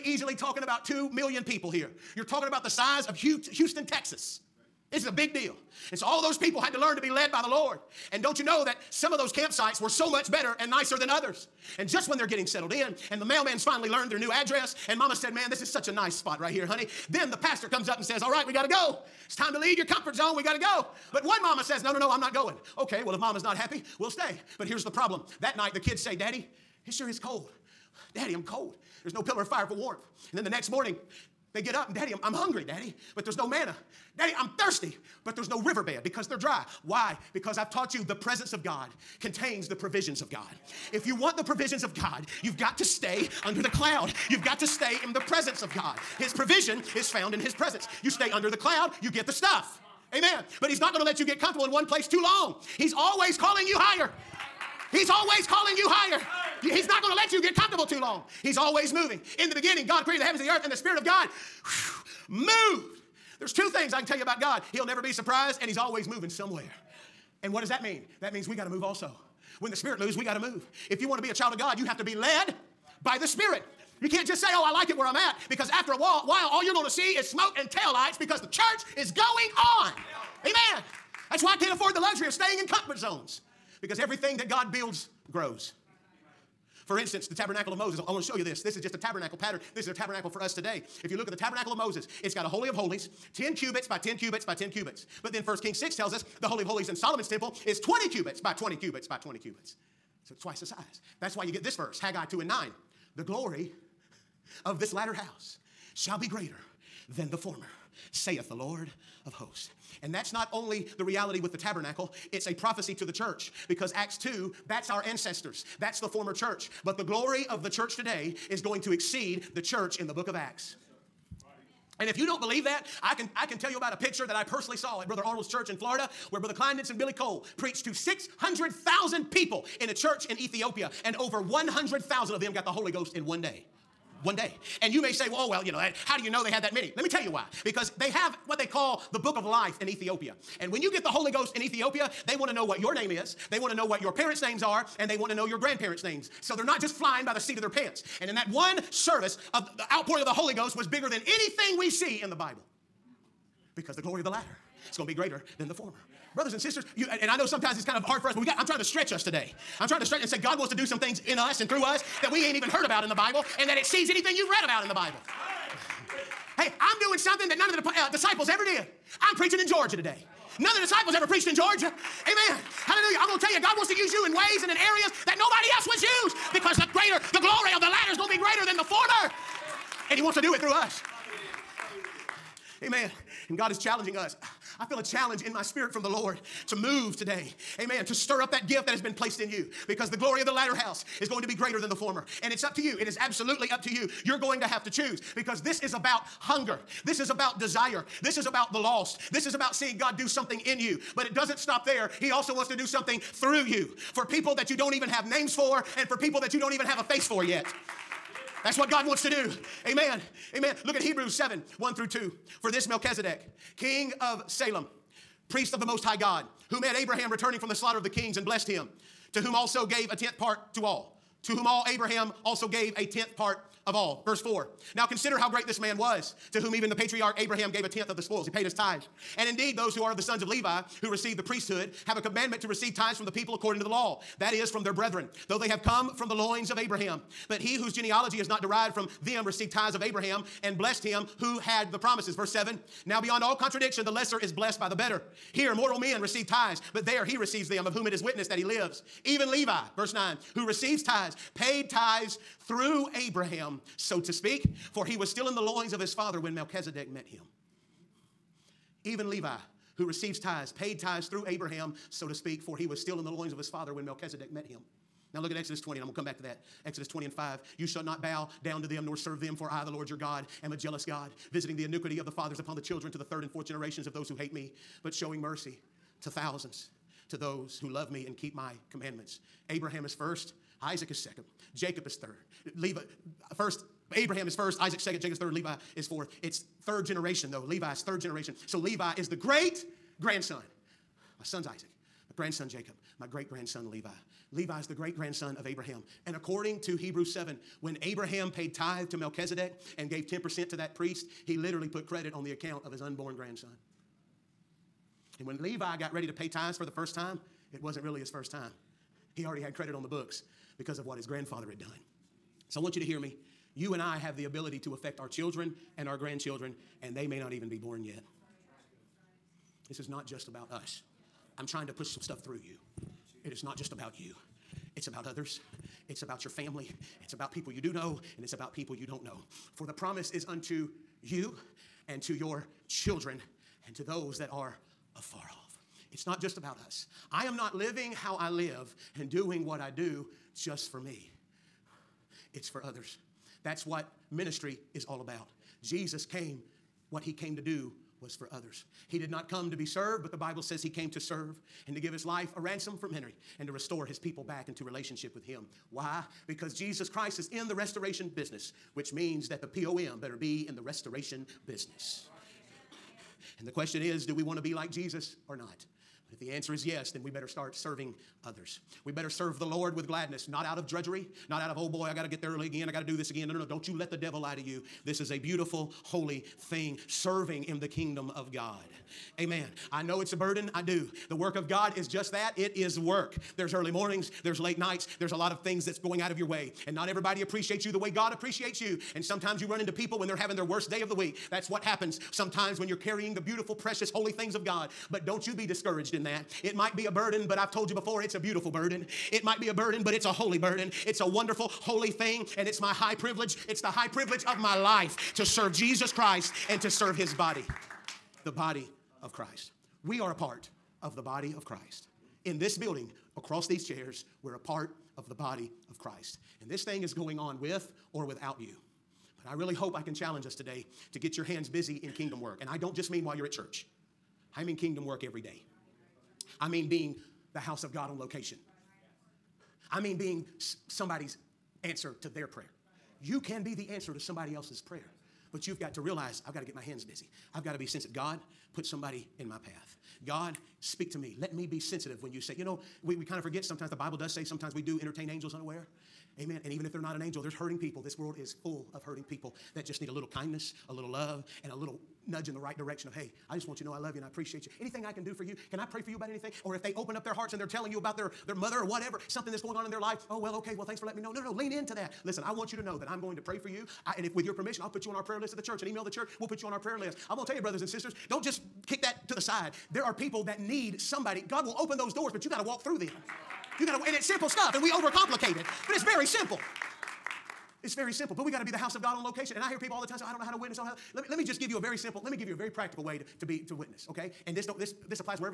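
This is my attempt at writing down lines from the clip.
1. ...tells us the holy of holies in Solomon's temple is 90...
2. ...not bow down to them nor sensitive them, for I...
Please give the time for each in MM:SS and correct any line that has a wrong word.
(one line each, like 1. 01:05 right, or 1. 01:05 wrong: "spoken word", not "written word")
1. 01:35 wrong: "20", not "90"
2. 04:28 wrong: "serve", not "sensitive".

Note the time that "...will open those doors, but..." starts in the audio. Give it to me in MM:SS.
07:51.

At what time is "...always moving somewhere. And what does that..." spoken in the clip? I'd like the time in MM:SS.
01:05.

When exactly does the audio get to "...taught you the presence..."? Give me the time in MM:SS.
00:37.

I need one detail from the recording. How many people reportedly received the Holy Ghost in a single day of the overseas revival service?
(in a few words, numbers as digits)
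over 100,000.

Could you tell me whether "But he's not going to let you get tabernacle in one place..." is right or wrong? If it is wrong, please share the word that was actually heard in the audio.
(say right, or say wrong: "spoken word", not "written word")
wrong: "comfortable", not "tabernacle".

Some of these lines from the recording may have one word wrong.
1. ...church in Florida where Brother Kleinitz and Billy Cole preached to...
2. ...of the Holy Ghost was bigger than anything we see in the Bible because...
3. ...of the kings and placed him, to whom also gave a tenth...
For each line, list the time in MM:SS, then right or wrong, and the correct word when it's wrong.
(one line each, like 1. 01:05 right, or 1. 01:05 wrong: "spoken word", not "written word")
1. 02:05 right
2. 02:30 right
3. 03:37 wrong: "blessed", not "placed".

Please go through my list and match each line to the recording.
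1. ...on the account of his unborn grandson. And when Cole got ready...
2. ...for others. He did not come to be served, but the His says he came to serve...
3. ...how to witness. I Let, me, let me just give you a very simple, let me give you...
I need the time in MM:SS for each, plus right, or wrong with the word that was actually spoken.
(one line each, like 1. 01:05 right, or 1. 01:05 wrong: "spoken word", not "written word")
1. 05:02 wrong: "Levi", not "Cole"
2. 05:48 wrong: "Bible", not "His"
3. 08:00 right.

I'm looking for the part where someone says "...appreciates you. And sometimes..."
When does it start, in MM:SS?
06:28.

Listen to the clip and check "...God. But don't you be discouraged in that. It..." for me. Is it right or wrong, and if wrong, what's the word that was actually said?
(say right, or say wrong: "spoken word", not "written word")
right.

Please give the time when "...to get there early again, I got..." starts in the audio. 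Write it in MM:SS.
06:12.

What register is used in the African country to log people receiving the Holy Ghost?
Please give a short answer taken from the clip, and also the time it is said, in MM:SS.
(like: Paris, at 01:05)
book of life, at 02:19.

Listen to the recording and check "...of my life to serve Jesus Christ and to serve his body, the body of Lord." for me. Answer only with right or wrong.
wrong.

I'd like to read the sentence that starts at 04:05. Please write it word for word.
Here, mortal men receive tithes, but there he receives them, of whom it is witnessed that he lives.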